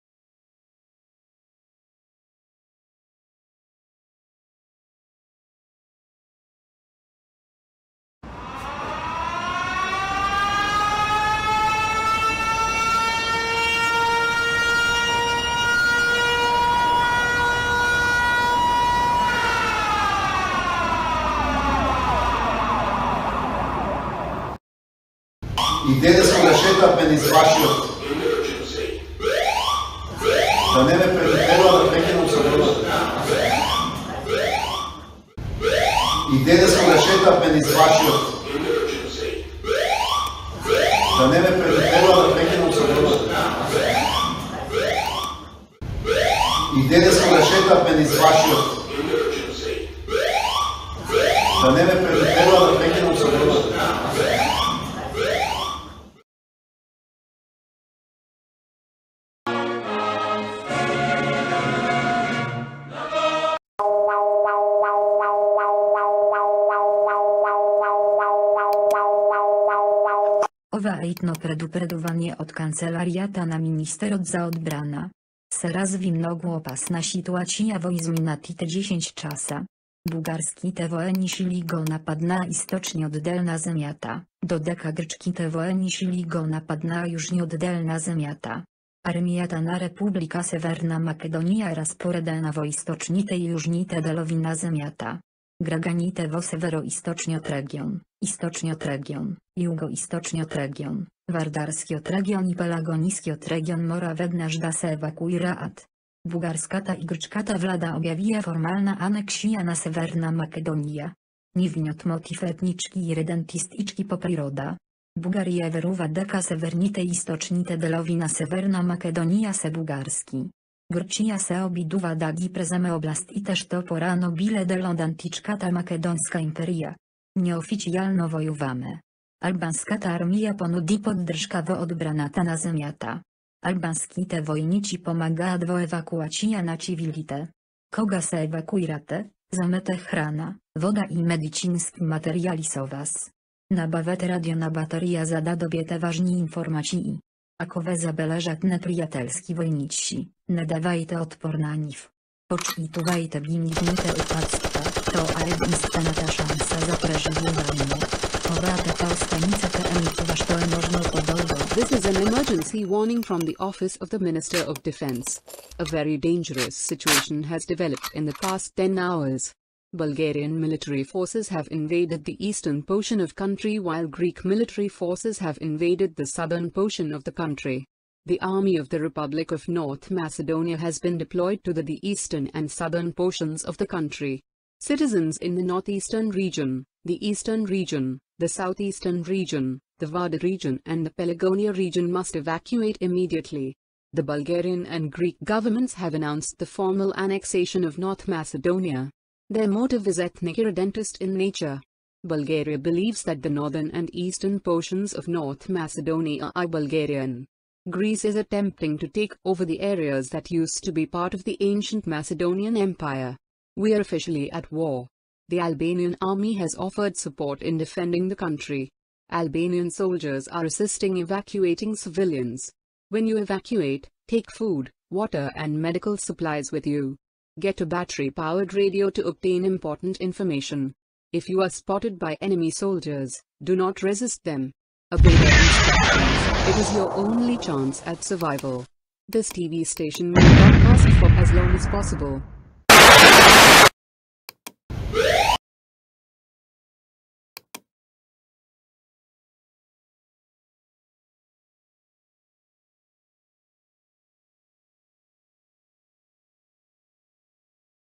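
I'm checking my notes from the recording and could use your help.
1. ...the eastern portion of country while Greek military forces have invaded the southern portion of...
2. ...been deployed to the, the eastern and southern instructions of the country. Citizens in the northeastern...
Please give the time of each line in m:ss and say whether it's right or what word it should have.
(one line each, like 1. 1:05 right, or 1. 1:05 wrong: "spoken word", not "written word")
1. 2:52 right
2. 3:00 wrong: "portions", not "instructions".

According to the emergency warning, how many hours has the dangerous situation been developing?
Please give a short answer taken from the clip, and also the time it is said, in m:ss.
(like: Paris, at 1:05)
10, at 2:48.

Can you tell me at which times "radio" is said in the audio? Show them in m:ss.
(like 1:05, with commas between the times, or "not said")
2:24, 3:48.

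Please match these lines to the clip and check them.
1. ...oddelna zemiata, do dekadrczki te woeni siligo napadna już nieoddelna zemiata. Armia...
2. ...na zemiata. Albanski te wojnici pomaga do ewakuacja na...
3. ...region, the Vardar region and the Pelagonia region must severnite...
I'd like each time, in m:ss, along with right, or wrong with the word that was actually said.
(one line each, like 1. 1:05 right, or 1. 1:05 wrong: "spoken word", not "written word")
1. 1:23 right
2. 2:12 right
3. 3:09 wrong: "evacuate", not "severnite".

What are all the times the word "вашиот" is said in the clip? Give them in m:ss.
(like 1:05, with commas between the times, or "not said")
0:27, 0:37, 0:48.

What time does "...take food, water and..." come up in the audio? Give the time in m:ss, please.
3:44.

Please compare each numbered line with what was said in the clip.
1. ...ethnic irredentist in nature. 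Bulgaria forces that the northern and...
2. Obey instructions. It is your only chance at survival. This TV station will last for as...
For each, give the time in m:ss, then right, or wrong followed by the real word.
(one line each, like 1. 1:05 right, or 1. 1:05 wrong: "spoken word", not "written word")
1. 3:20 wrong: "believes", not "forces"
2. 3:55 right.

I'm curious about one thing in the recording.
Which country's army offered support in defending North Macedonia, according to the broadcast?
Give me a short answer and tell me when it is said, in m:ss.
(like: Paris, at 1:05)
Albanian army, at 3:35.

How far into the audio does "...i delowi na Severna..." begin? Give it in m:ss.
1:57.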